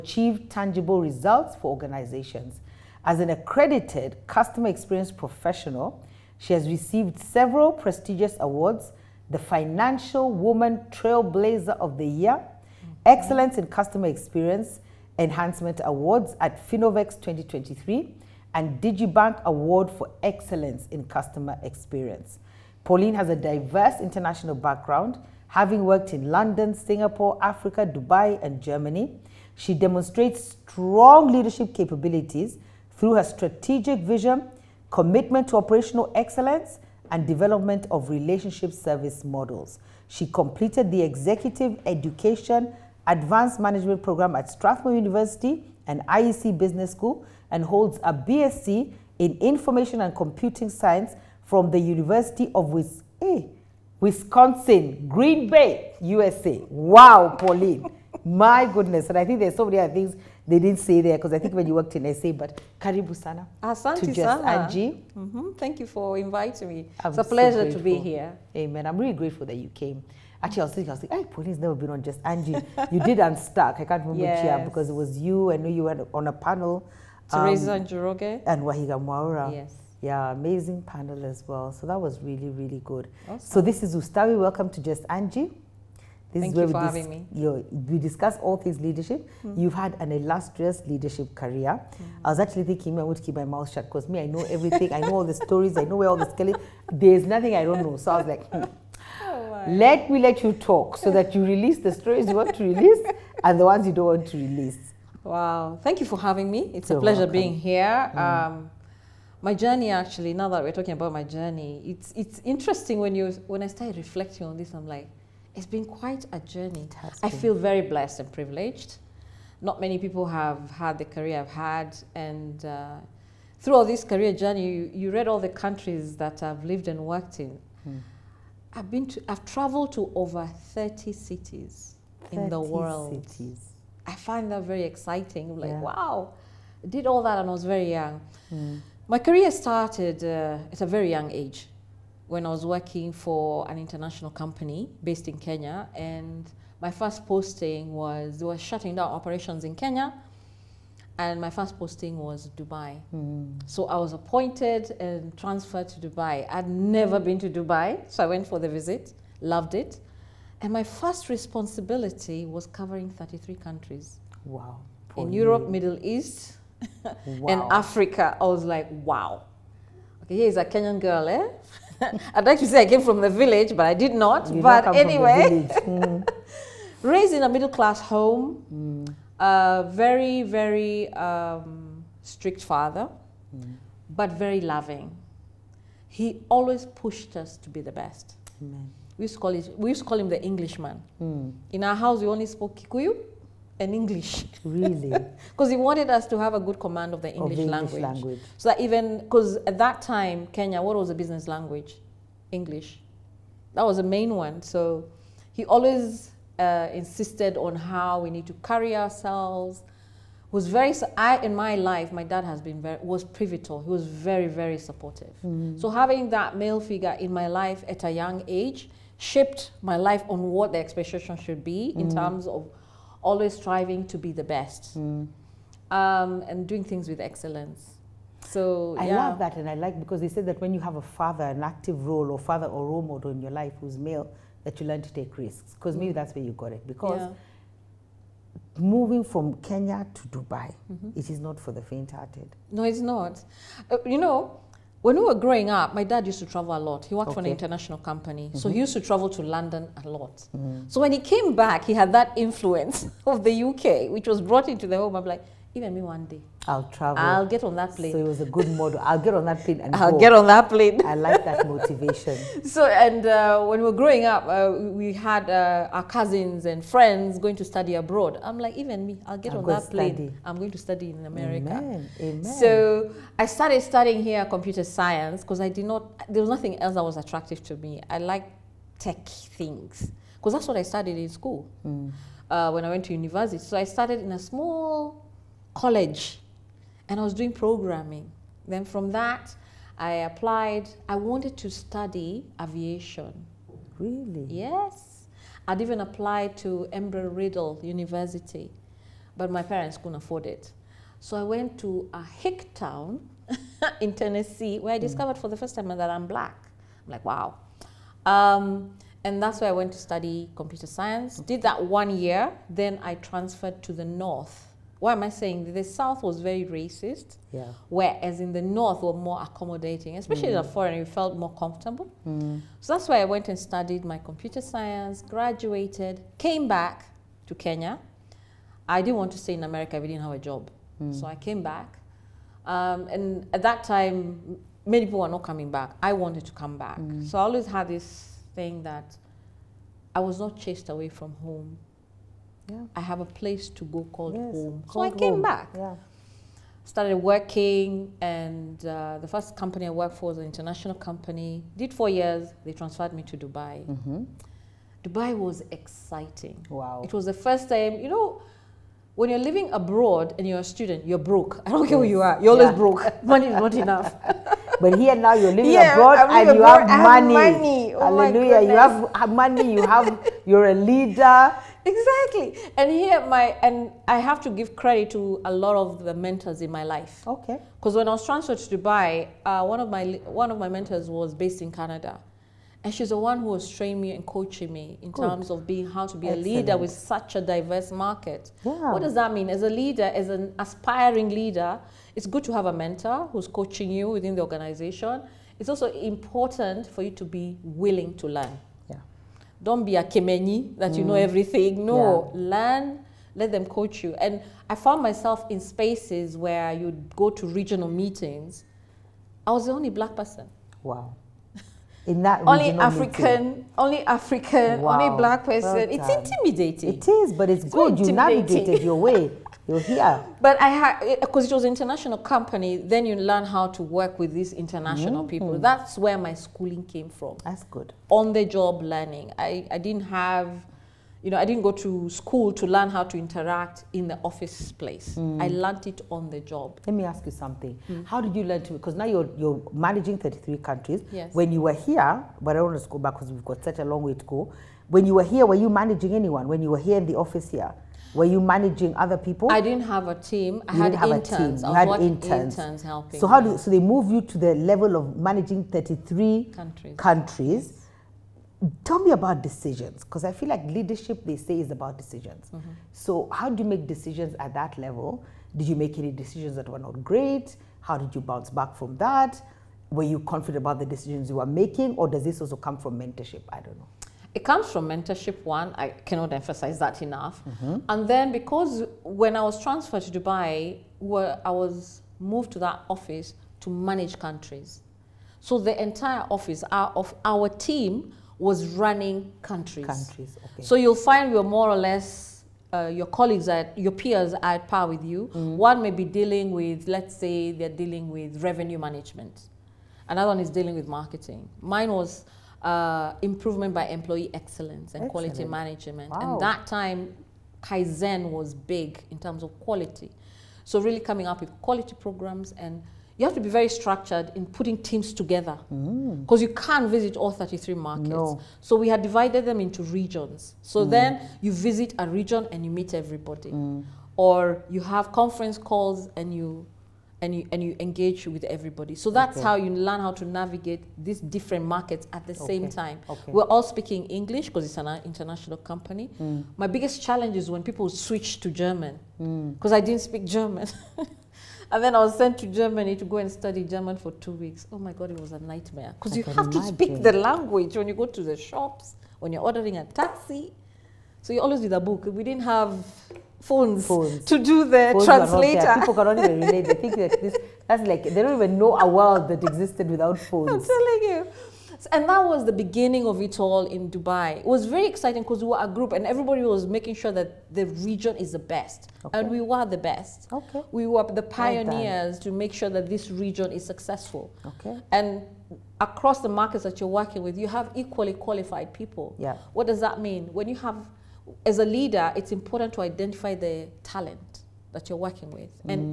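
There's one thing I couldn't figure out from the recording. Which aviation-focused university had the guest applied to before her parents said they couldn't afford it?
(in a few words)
Embry Riddle University.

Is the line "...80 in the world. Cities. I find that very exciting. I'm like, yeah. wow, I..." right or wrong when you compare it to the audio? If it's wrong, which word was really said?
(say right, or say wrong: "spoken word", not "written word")
wrong: "30", not "80".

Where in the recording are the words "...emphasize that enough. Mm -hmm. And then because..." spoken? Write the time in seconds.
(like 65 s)
476 s.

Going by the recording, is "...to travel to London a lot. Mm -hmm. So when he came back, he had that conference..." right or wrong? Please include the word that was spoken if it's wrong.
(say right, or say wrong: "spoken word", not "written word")
wrong: "influence", not "conference".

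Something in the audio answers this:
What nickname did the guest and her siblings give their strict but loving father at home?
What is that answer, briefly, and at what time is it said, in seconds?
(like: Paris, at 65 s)
The Englishman, at 190 s.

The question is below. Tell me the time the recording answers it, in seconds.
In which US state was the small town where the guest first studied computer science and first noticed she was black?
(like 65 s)
304 s.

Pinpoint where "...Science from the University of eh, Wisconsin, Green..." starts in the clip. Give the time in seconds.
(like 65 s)
50 s.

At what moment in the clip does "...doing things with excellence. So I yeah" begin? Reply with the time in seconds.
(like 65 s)
226 s.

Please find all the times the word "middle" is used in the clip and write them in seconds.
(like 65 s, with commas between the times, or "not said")
165 s, 177 s.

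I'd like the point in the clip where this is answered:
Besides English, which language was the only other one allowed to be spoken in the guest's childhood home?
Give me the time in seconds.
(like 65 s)
192 s.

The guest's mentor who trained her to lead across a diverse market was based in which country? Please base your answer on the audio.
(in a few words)
Canada.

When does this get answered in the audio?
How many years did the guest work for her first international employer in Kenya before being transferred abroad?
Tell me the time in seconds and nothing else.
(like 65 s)
351 s.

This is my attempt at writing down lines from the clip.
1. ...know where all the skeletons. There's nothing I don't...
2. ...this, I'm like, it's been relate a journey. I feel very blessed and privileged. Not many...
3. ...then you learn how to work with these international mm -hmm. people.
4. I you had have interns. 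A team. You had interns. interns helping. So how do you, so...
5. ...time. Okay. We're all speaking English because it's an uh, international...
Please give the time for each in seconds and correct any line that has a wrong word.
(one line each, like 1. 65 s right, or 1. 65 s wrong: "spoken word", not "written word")
1. 95 s right
2. 114 s wrong: "quite", not "relate"
3. 422 s right
4. 450 s right
5. 532 s right.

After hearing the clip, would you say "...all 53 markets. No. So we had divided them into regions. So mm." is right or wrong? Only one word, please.
wrong.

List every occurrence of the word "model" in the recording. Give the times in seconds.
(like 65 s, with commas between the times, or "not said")
39 s, 233 s, 258 s.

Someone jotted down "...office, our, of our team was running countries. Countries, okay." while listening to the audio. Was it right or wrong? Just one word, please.
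right.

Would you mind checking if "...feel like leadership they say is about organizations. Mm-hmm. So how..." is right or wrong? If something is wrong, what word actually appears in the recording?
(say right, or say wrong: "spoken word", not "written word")
wrong: "decisions", not "organizations".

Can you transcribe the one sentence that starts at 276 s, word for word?
There was nothing else that was attractive to me.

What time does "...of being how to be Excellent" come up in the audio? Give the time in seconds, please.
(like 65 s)
385 s.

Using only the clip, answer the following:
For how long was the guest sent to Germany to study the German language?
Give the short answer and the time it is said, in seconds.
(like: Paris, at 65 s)
2 weeks, at 544 s.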